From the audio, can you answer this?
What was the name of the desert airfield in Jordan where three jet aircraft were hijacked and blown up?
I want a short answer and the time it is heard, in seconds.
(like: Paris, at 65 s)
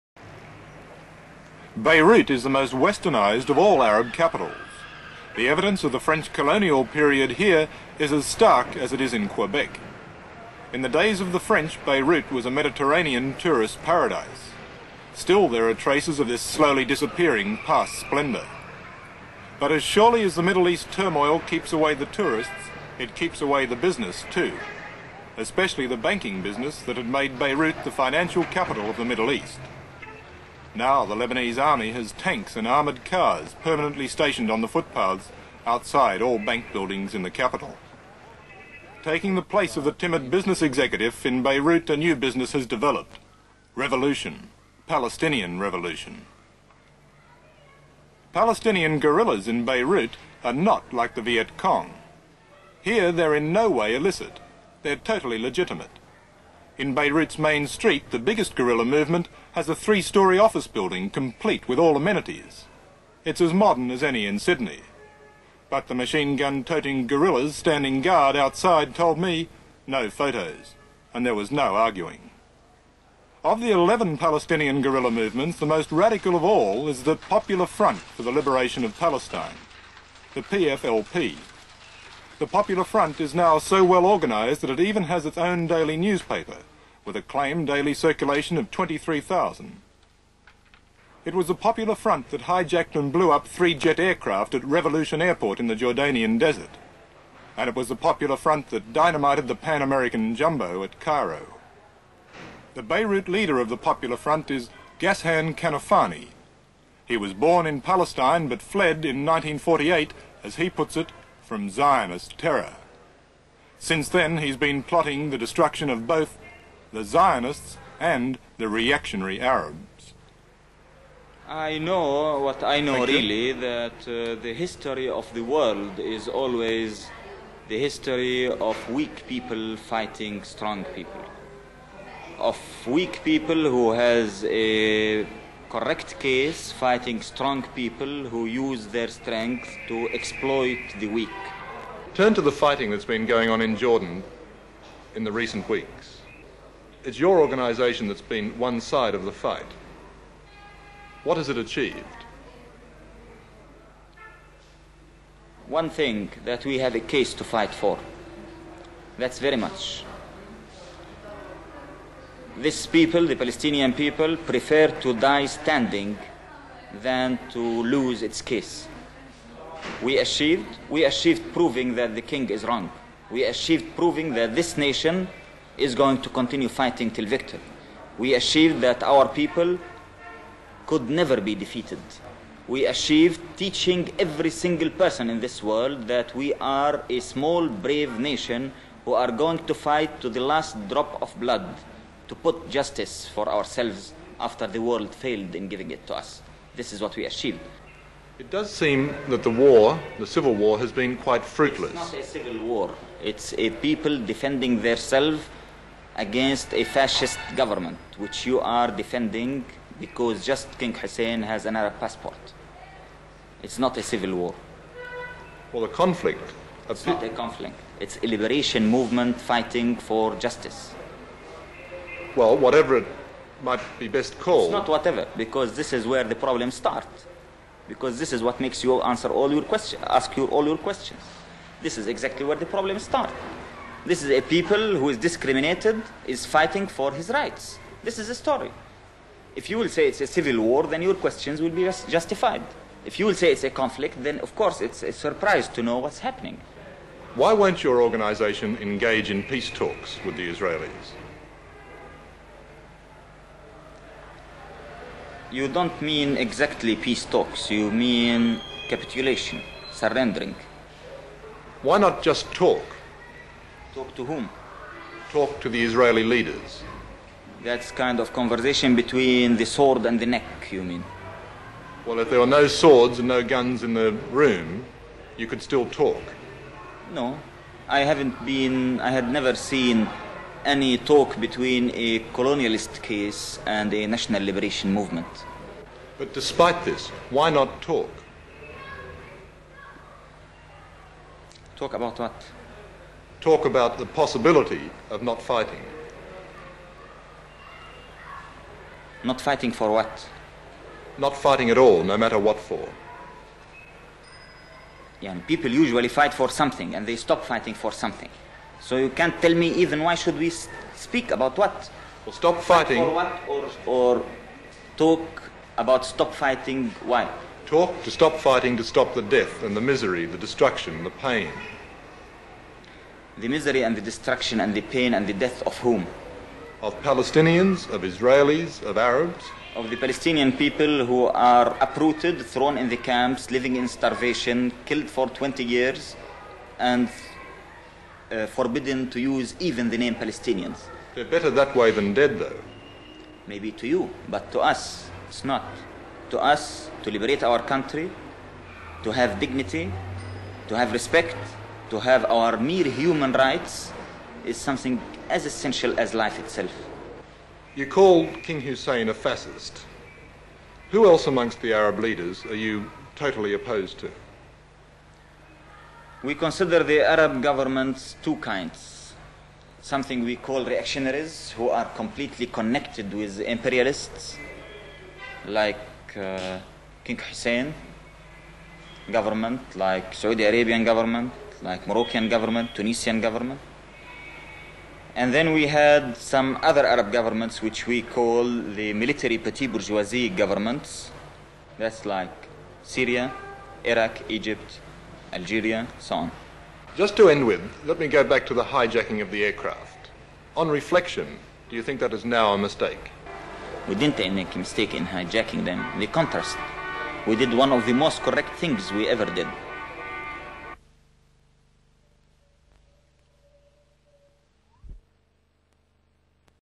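Revolution Airport, at 94 s.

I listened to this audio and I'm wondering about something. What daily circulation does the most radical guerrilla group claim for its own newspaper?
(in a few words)
23,000.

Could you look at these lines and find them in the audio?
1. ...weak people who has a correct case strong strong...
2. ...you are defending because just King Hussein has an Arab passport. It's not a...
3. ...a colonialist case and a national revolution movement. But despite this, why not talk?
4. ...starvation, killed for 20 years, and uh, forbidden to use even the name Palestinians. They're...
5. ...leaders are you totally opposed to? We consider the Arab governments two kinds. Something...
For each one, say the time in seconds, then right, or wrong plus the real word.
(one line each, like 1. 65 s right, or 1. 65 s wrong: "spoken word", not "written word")
1. 132 s wrong: "fighting", not "strong"
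2. 208 s right
3. 281 s wrong: "liberation", not "revolution"
4. 333 s right
5. 361 s right.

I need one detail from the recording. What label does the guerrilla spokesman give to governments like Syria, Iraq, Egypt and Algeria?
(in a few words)
military petit bourgeoisie.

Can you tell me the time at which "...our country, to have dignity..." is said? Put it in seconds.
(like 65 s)
347 s.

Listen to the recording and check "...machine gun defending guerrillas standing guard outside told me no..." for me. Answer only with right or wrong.
wrong.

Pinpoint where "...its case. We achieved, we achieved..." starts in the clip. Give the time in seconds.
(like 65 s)
168 s.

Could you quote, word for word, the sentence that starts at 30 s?
Now the Lebanese army has tanks and armoured cars permanently stationed on the footpaths outside all bank buildings in the capital.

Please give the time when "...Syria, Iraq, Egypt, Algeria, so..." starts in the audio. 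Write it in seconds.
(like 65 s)
392 s.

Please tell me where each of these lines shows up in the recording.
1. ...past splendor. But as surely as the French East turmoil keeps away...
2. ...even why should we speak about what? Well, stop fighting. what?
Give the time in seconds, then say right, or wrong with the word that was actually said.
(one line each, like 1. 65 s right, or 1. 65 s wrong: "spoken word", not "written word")
1. 17 s wrong: "Middle", not "French"
2. 309 s right.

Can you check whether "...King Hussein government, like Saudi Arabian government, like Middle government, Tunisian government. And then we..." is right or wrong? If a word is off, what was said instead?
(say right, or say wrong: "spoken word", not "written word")
wrong: "Moroccan", not "Middle".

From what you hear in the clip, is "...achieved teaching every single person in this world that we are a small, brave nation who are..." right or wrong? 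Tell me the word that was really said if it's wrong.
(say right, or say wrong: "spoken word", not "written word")
right.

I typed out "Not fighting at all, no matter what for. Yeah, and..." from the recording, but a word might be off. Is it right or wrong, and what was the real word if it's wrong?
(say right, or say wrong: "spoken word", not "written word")
right.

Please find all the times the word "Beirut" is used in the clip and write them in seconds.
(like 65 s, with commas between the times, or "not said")
1 s, 11 s, 27 s, 41 s, 49 s, 56 s, 102 s.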